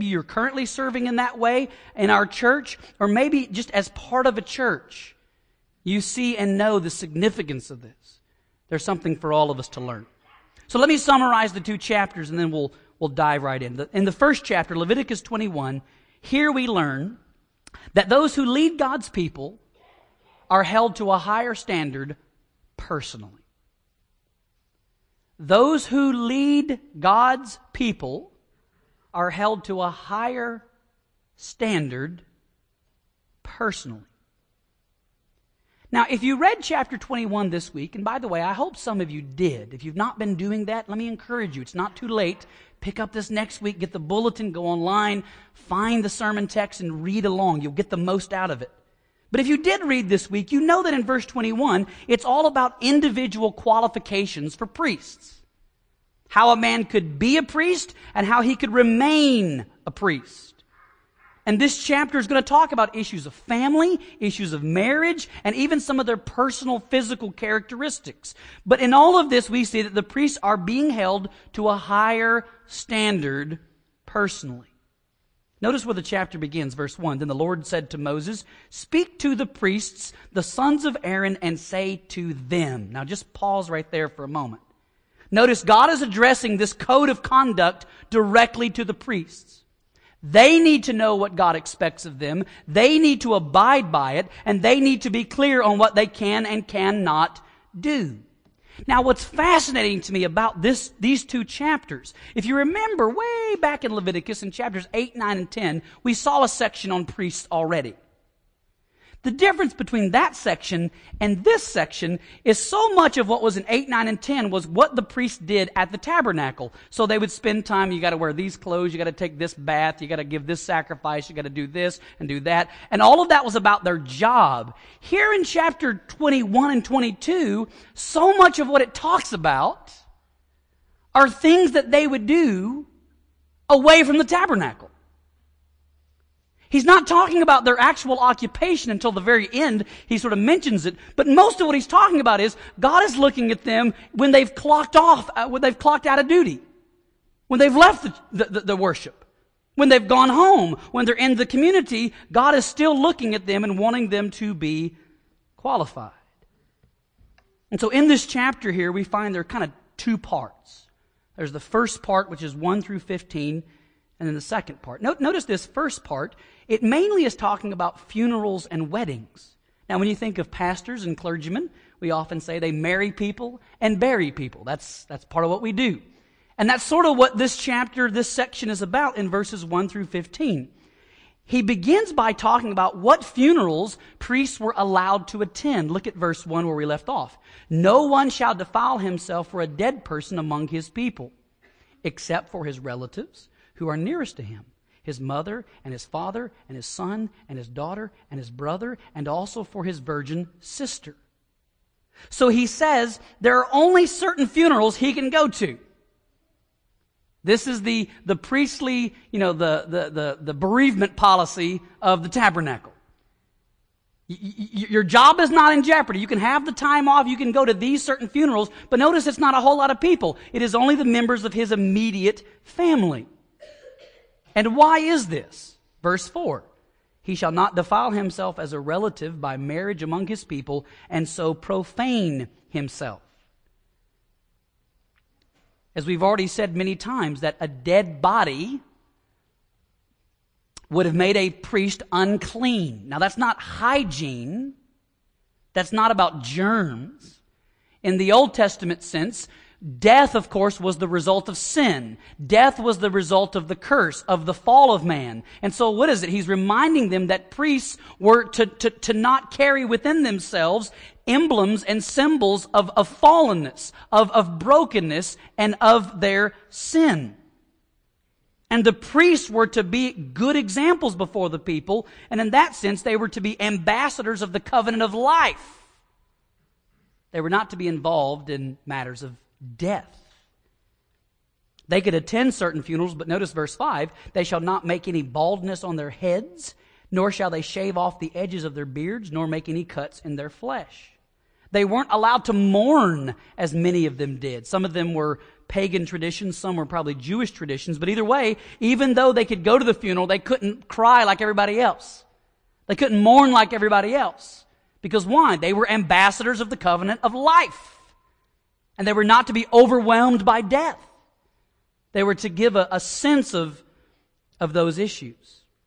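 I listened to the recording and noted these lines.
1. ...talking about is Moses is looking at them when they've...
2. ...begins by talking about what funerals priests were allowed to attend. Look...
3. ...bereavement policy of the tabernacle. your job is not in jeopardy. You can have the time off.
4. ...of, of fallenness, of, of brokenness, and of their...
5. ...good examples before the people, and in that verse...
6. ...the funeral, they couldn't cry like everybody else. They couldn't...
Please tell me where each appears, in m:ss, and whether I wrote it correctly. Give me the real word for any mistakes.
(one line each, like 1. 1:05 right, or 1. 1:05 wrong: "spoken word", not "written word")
1. 2:21 wrong: "God", not "Moses"
2. 3:01 right
3. 3:30 right
4. 4:22 right
5. 4:30 wrong: "sense", not "verse"
6. 4:59 right.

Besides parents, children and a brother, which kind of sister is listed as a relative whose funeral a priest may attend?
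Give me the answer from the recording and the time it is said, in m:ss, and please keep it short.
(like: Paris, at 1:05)
Virgin sister, at 3:19.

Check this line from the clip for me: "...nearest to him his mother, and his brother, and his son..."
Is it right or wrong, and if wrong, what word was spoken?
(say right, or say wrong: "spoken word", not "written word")
wrong: "father", not "brother".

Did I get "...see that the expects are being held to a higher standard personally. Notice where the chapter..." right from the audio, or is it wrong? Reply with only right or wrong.
wrong.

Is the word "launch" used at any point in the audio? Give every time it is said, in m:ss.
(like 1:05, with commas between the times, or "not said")
not said.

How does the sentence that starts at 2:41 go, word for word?
There's the first part, which is 1 through 15, and then the second part.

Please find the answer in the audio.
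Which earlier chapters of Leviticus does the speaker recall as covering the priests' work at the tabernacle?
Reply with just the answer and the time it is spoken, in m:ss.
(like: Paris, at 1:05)
8, 9, and 10, at 1:44.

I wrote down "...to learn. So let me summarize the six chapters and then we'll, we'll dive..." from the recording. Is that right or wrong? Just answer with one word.
wrong.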